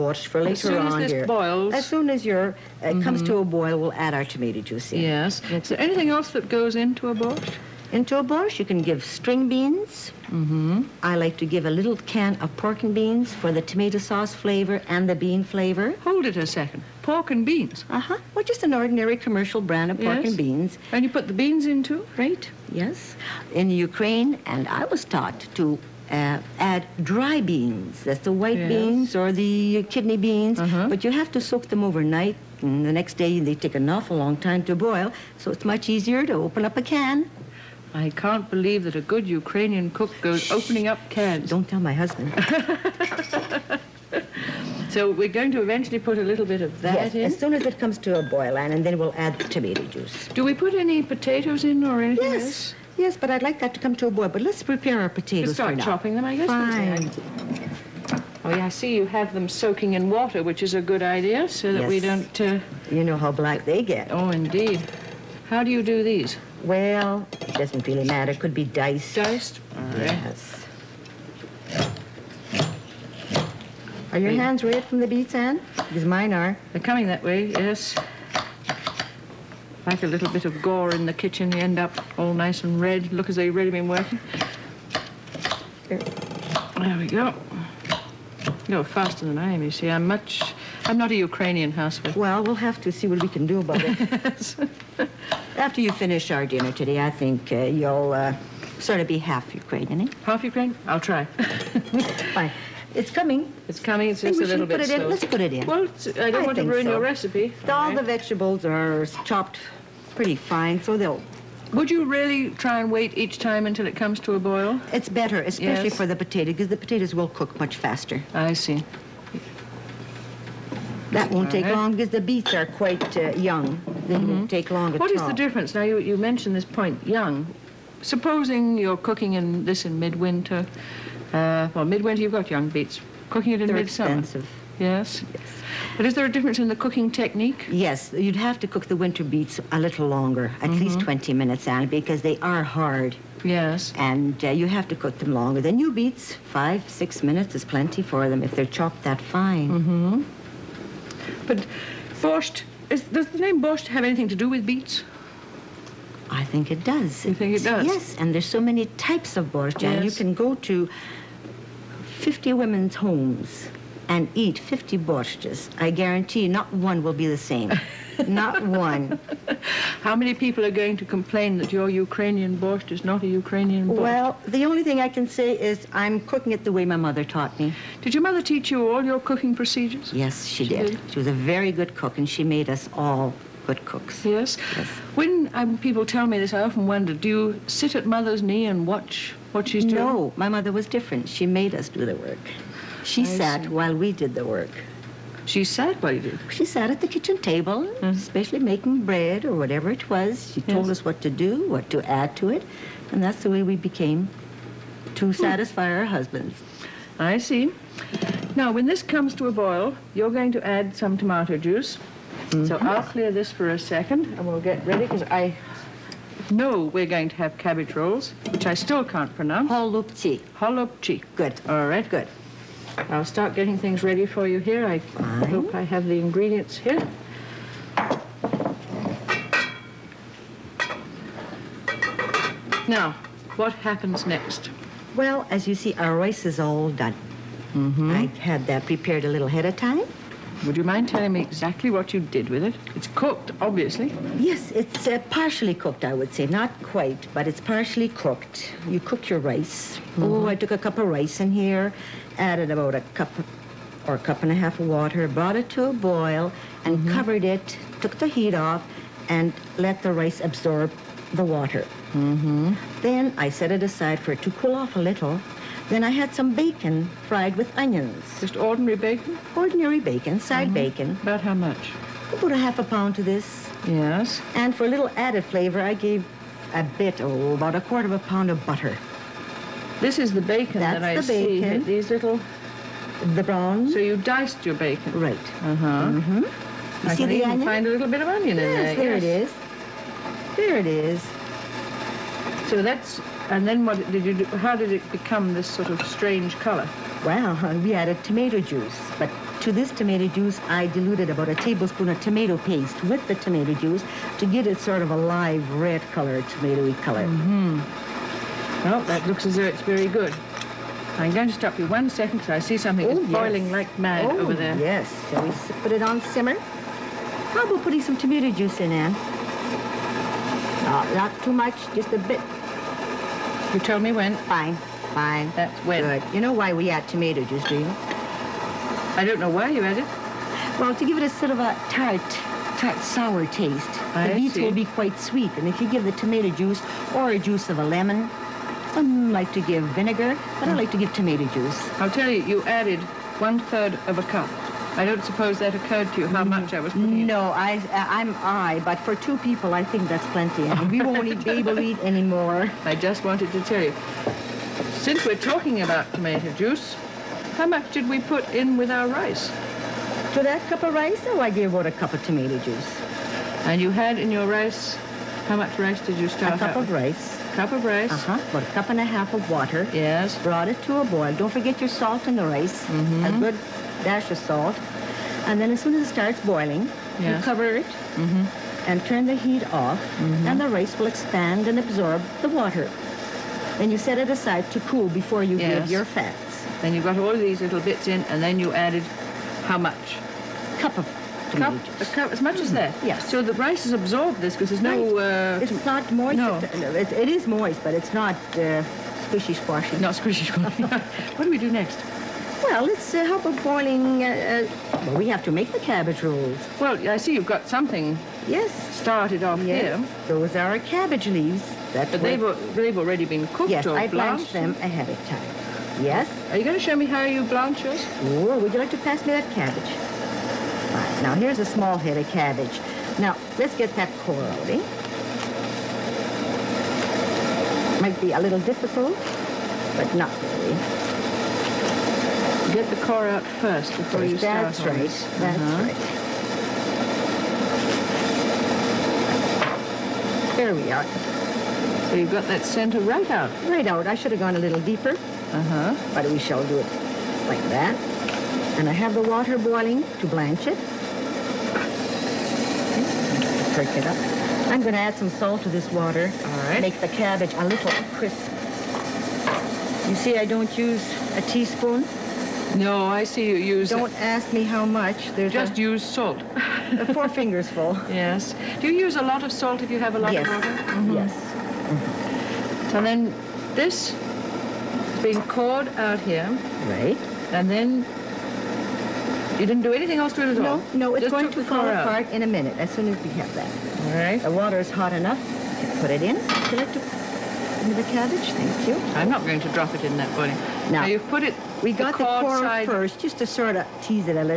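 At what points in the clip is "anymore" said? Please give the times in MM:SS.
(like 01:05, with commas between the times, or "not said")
05:52.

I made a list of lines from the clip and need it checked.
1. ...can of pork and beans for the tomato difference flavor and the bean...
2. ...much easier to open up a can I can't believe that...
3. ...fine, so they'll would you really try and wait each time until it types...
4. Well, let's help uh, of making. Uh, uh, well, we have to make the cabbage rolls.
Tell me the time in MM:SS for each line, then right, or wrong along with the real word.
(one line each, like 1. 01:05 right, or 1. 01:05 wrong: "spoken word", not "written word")
1. 00:12 wrong: "sauce", not "difference"
2. 00:35 right
3. 01:50 wrong: "comes", not "types"
4. 06:42 wrong: "boiling", not "making".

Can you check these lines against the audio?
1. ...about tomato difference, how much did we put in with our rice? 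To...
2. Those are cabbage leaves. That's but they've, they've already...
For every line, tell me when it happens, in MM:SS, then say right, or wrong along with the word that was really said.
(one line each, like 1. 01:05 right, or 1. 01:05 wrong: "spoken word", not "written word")
1. 05:55 wrong: "juice", not "difference"
2. 06:50 right.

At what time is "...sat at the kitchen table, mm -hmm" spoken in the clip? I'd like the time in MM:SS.
03:16.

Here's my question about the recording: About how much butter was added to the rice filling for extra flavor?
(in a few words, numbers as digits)
a quarter of a pound.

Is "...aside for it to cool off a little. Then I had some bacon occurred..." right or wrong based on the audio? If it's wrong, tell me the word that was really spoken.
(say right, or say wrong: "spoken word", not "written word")
wrong: "fried", not "occurred".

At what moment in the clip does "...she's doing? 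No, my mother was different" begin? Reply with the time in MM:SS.
03:09.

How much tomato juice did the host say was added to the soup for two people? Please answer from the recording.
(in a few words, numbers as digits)
one third of a cup.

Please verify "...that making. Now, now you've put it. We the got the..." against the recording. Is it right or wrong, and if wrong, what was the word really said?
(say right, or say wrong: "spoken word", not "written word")
wrong: "boiling", not "making".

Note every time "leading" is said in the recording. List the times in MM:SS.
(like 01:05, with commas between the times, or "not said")
not said.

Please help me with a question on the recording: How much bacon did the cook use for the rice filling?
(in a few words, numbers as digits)
half a pound.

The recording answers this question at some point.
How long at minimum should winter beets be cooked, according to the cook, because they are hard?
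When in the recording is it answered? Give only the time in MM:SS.
02:20.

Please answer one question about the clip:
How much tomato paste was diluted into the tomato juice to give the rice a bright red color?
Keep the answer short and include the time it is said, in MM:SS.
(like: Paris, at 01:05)
a tablespoon, at 05:01.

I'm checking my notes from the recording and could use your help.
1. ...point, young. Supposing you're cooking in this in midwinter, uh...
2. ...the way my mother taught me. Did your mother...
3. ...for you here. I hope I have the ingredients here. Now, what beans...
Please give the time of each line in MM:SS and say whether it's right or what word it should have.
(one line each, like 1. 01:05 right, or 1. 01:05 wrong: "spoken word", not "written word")
1. 02:06 right
2. 02:56 right
3. 03:44 wrong: "happens", not "beans".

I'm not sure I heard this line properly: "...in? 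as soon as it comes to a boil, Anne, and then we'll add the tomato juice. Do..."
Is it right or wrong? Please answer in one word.
right.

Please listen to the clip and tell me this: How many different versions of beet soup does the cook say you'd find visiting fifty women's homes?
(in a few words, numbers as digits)
50.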